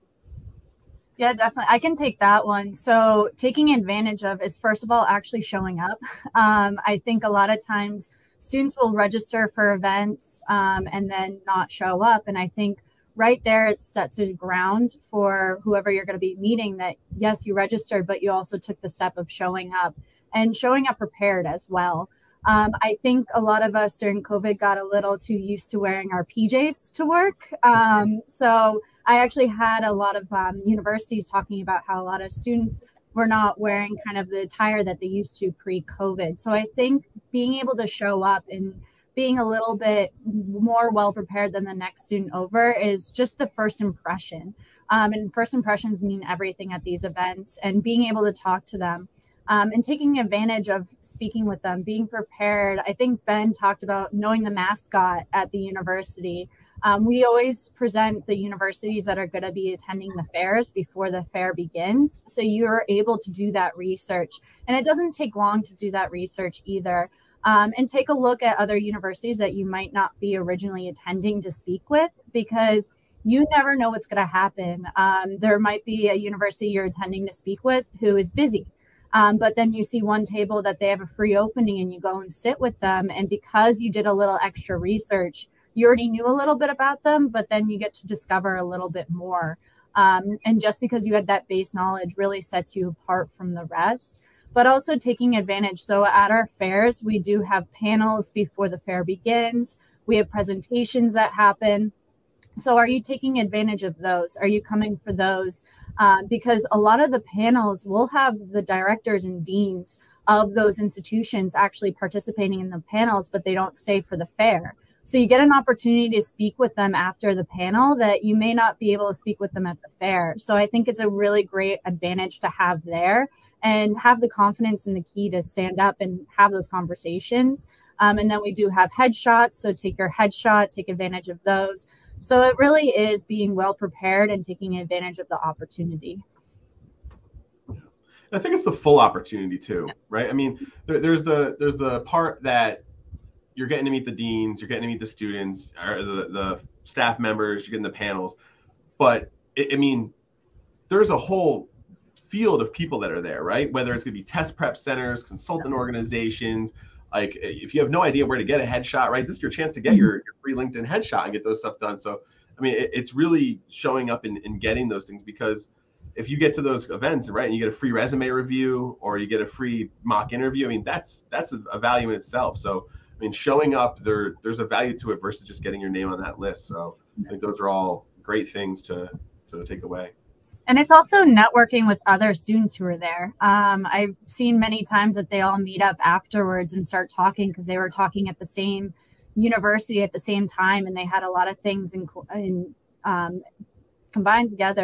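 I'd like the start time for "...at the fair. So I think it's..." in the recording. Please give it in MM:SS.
01:59.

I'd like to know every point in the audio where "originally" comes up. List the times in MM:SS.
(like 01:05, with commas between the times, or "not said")
01:10.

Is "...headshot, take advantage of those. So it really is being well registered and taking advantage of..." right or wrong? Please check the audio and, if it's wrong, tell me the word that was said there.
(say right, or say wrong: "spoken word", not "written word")
wrong: "prepared", not "registered".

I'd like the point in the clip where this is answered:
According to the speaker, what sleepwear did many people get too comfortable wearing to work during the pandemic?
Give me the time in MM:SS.
00:26.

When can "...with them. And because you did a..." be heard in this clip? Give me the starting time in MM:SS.
01:22.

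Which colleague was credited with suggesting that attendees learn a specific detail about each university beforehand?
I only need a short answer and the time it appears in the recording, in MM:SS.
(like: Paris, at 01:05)
Ben, at 00:53.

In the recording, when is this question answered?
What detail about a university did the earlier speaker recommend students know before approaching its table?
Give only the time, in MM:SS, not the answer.
00:54.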